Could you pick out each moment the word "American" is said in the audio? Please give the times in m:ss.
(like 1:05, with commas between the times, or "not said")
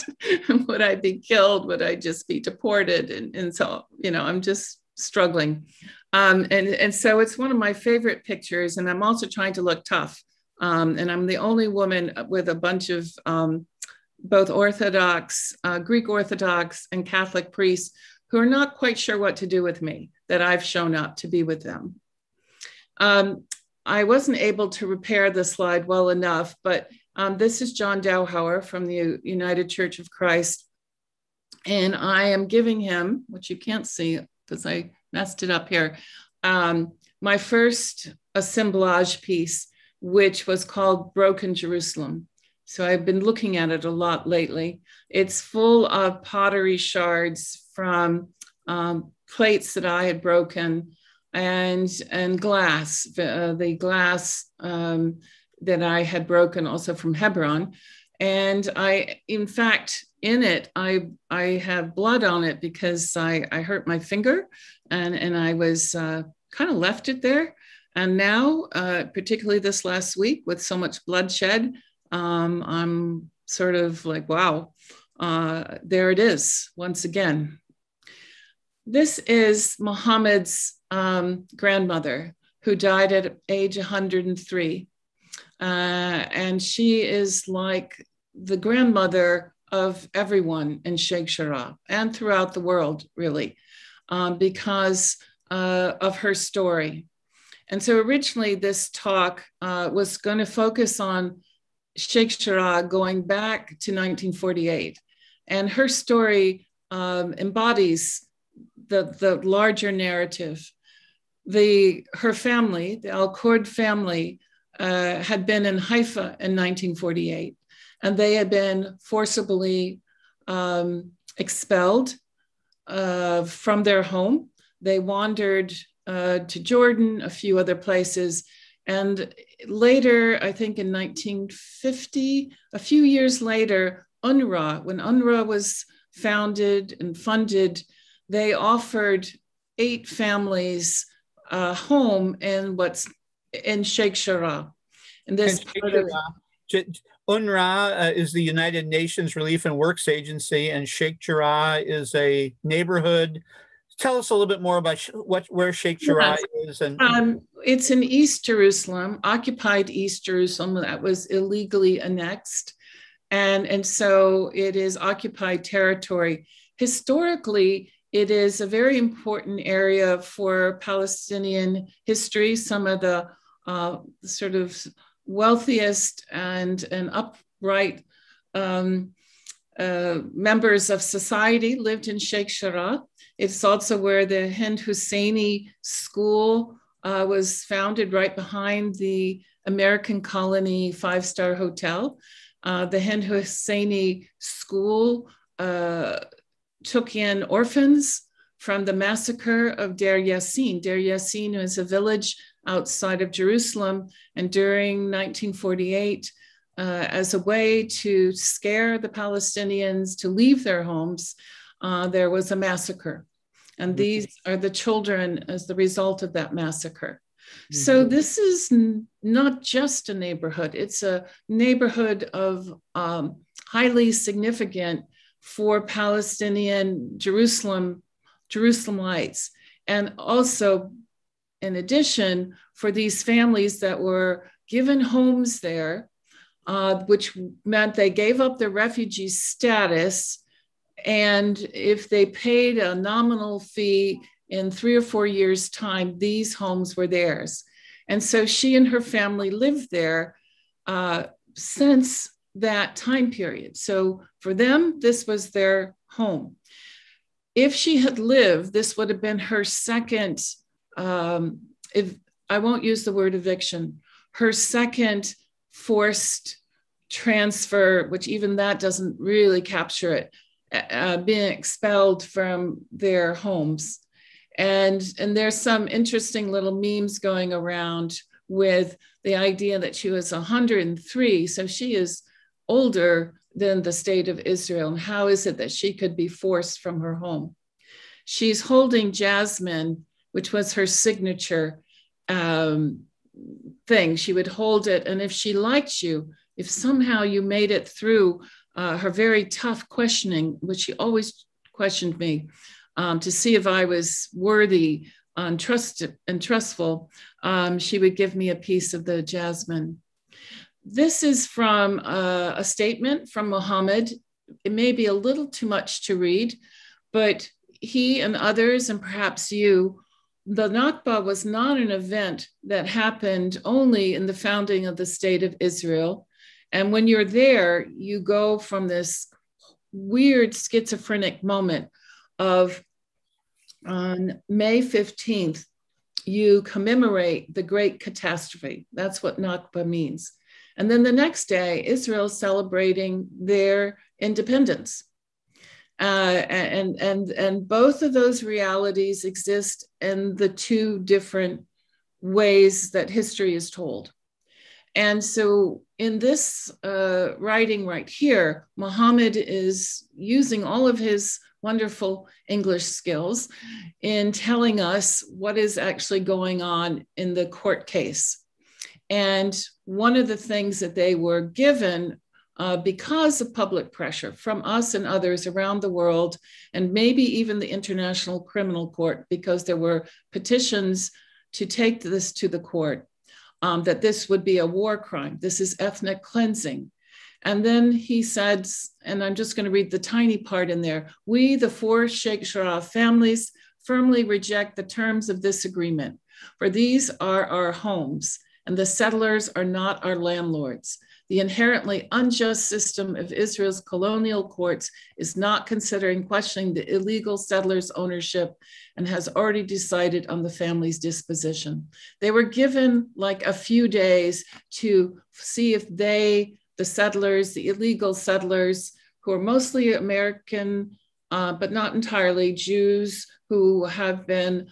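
3:09, 6:59.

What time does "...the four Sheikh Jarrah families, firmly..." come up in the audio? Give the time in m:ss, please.
6:31.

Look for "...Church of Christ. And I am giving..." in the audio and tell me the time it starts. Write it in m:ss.
0:29.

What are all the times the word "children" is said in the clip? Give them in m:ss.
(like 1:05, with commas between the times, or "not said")
3:34.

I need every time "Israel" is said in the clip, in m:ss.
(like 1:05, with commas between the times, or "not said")
4:44, 5:25, 6:43.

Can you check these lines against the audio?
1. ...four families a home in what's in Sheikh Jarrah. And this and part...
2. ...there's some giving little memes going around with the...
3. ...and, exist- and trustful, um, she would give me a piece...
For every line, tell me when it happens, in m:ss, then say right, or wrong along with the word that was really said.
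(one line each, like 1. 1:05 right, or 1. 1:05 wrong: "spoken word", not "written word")
1. 2:19 wrong: "eight", not "four"
2. 4:35 wrong: "interesting", not "giving"
3. 5:05 wrong: "trust", not "exist".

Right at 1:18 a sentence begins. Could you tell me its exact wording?
This is Muhammad's um, grandmother who died at age 103.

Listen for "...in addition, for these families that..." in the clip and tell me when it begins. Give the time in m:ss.
3:51.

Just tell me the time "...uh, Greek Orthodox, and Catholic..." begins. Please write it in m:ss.
0:15.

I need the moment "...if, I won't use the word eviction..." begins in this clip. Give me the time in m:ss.
4:21.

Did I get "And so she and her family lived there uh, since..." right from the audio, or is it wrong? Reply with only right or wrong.
right.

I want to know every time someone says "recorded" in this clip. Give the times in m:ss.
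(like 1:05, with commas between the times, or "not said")
not said.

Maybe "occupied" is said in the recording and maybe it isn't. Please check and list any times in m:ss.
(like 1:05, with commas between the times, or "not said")
2:39, 2:44.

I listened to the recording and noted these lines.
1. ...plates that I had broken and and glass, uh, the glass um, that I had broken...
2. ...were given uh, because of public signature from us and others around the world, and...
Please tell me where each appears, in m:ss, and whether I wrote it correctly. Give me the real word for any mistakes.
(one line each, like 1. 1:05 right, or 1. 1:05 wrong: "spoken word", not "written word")
1. 0:49 right
2. 6:11 wrong: "pressure", not "signature".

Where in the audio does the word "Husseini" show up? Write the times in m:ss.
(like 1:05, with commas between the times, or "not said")
3:04, 3:13.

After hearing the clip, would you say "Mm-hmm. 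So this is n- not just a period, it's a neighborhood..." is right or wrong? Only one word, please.
wrong.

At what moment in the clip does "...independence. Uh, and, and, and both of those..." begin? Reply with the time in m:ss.
5:44.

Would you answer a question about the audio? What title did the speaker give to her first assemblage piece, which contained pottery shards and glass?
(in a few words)
Broken Jerusalem.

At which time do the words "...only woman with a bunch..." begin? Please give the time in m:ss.
0:11.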